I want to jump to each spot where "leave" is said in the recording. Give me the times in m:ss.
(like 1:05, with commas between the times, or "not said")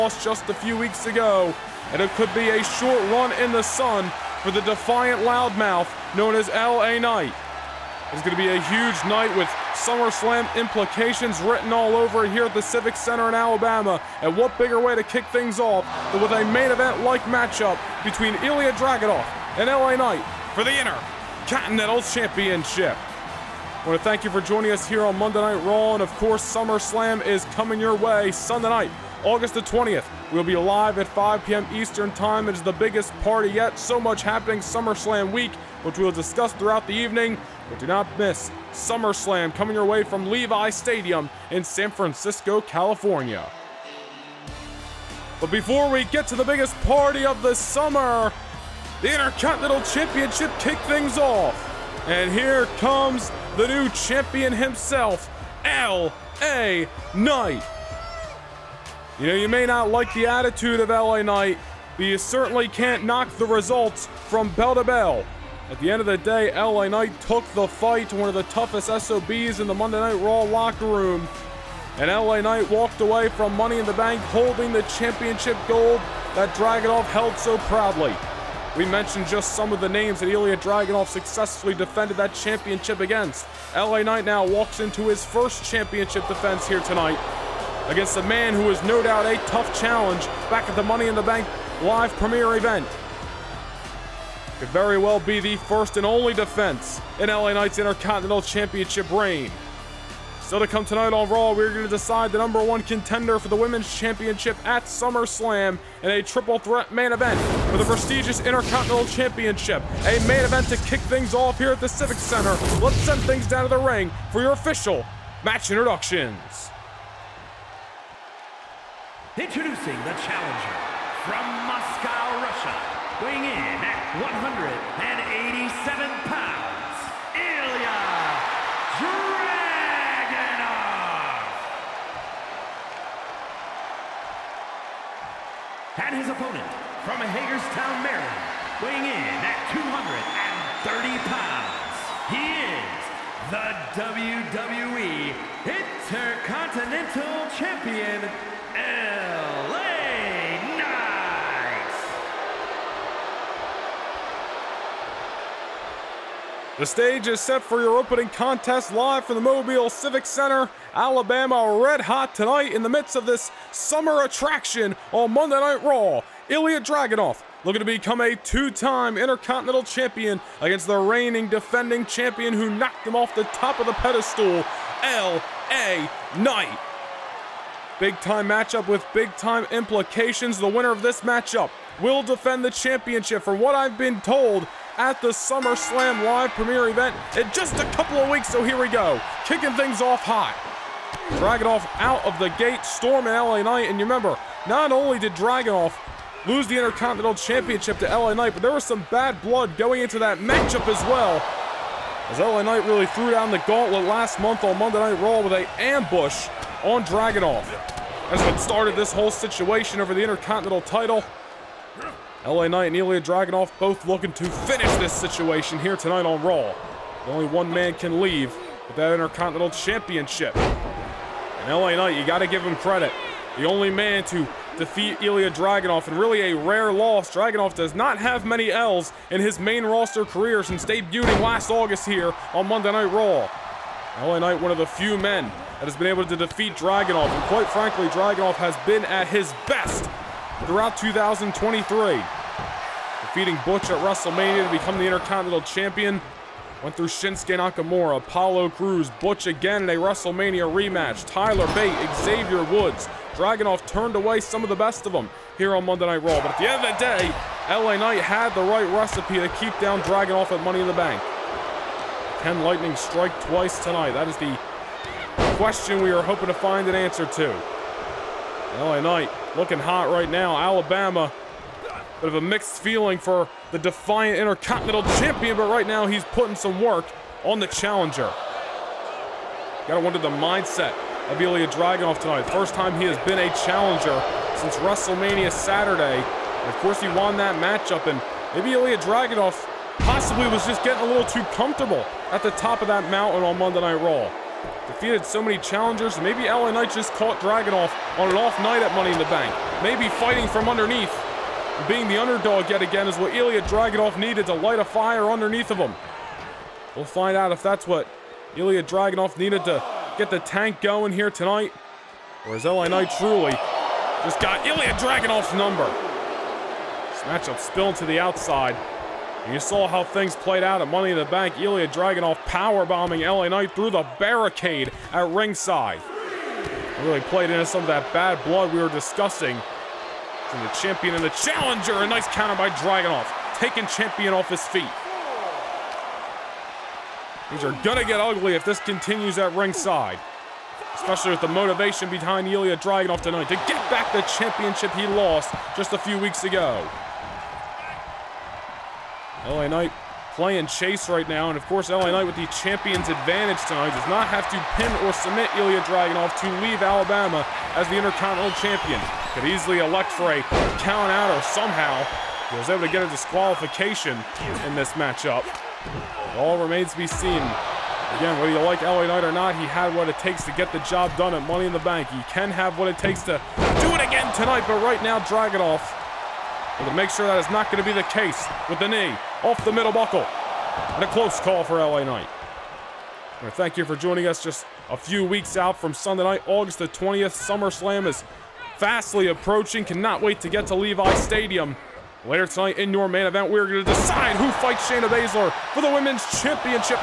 3:38, 5:56.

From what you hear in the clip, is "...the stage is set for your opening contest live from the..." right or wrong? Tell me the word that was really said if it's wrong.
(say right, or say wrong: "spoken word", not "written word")
right.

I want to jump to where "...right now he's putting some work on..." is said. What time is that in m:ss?
4:35.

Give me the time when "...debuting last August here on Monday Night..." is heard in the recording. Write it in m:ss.
3:50.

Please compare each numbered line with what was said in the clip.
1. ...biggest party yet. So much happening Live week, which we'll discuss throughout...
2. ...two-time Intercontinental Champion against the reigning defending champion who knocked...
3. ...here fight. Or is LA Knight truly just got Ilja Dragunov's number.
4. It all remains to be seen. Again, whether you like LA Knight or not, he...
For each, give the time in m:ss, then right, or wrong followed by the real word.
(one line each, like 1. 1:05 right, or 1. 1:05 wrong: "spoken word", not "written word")
1. 0:32 wrong: "SummerSlam", not "Live"
2. 2:48 right
3. 5:11 wrong: "tonight", not "fight"
4. 6:05 right.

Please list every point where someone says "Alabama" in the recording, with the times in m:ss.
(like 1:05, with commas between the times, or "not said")
0:13, 2:40, 4:30, 5:56.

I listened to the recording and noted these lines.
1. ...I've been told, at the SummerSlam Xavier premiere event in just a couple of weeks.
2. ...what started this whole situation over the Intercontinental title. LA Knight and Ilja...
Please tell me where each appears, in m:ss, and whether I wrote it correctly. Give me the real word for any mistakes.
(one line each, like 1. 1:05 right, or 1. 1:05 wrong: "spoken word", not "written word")
1. 3:03 wrong: "Live", not "Xavier"
2. 3:28 right.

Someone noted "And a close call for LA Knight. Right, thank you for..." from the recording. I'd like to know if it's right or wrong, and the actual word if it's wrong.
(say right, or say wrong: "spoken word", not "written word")
right.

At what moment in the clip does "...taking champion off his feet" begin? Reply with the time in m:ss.
5:33.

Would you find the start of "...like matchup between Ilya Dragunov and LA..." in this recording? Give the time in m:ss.
0:17.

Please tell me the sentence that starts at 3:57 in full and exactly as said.
And quite frankly, Dragunov has been at his best throughout 2023.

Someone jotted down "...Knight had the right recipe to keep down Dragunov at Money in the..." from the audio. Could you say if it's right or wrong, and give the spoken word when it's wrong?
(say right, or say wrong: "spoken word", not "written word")
right.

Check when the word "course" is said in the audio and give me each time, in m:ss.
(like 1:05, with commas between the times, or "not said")
0:26, 4:46, 5:51.